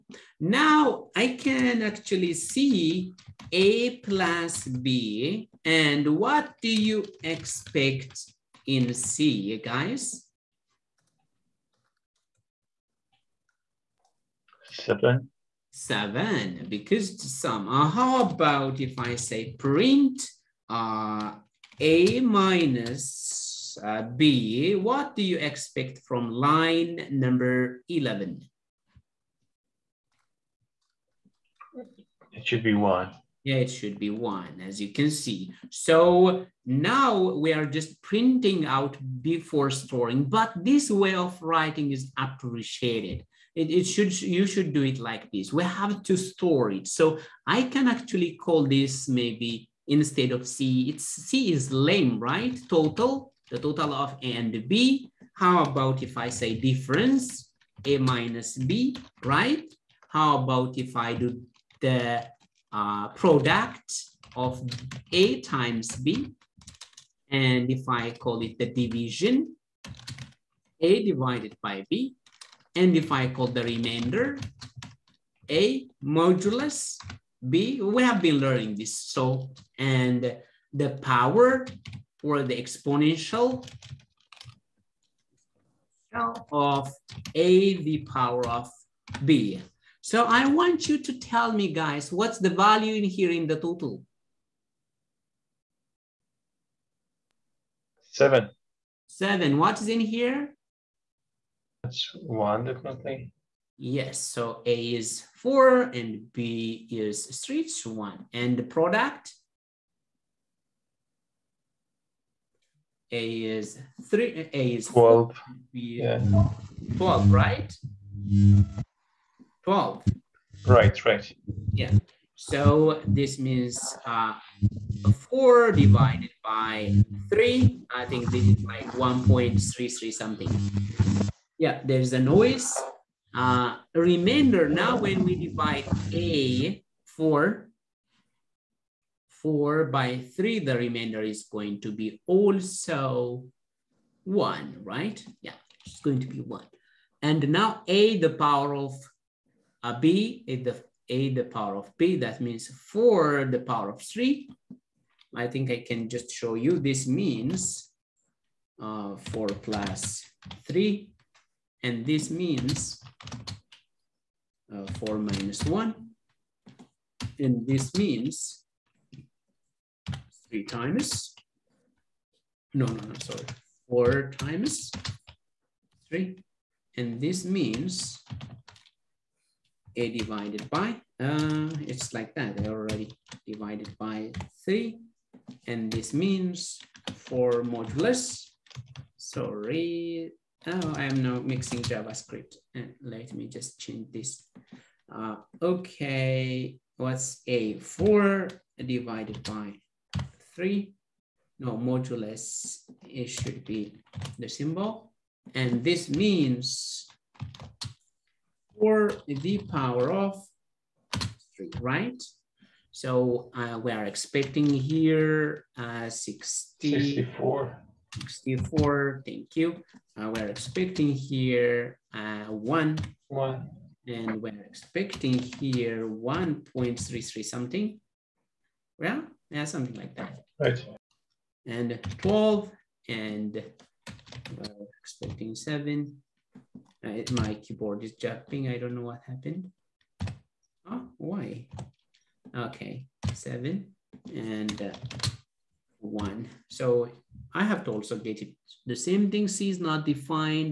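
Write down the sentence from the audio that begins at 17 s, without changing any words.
Uh, how about if I say print uh, A minus uh, B, what do you expect from line number 11?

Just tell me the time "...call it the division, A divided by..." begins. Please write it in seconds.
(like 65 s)
68 s.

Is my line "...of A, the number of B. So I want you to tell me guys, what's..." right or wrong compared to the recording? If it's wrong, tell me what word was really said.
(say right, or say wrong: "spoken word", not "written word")
wrong: "power", not "number".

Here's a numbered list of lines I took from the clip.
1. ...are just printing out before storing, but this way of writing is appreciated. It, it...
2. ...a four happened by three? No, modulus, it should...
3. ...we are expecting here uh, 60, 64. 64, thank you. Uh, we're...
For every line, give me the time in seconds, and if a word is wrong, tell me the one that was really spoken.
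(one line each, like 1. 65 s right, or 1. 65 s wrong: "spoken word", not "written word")
1. 37 s right
2. 197 s wrong: "divided", not "happened"
3. 213 s right.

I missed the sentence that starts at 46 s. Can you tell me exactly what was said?
So I can actually call this maybe instead of C.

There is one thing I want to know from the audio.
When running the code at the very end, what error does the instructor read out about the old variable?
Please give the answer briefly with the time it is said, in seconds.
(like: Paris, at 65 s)
C is not defined, at 249 s.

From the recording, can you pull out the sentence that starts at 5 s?
And what do you expect in C, guys?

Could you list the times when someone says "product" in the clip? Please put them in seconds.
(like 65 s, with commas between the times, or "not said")
63 s, 108 s.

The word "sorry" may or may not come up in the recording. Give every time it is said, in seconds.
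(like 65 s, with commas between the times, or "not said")
173 s, 189 s.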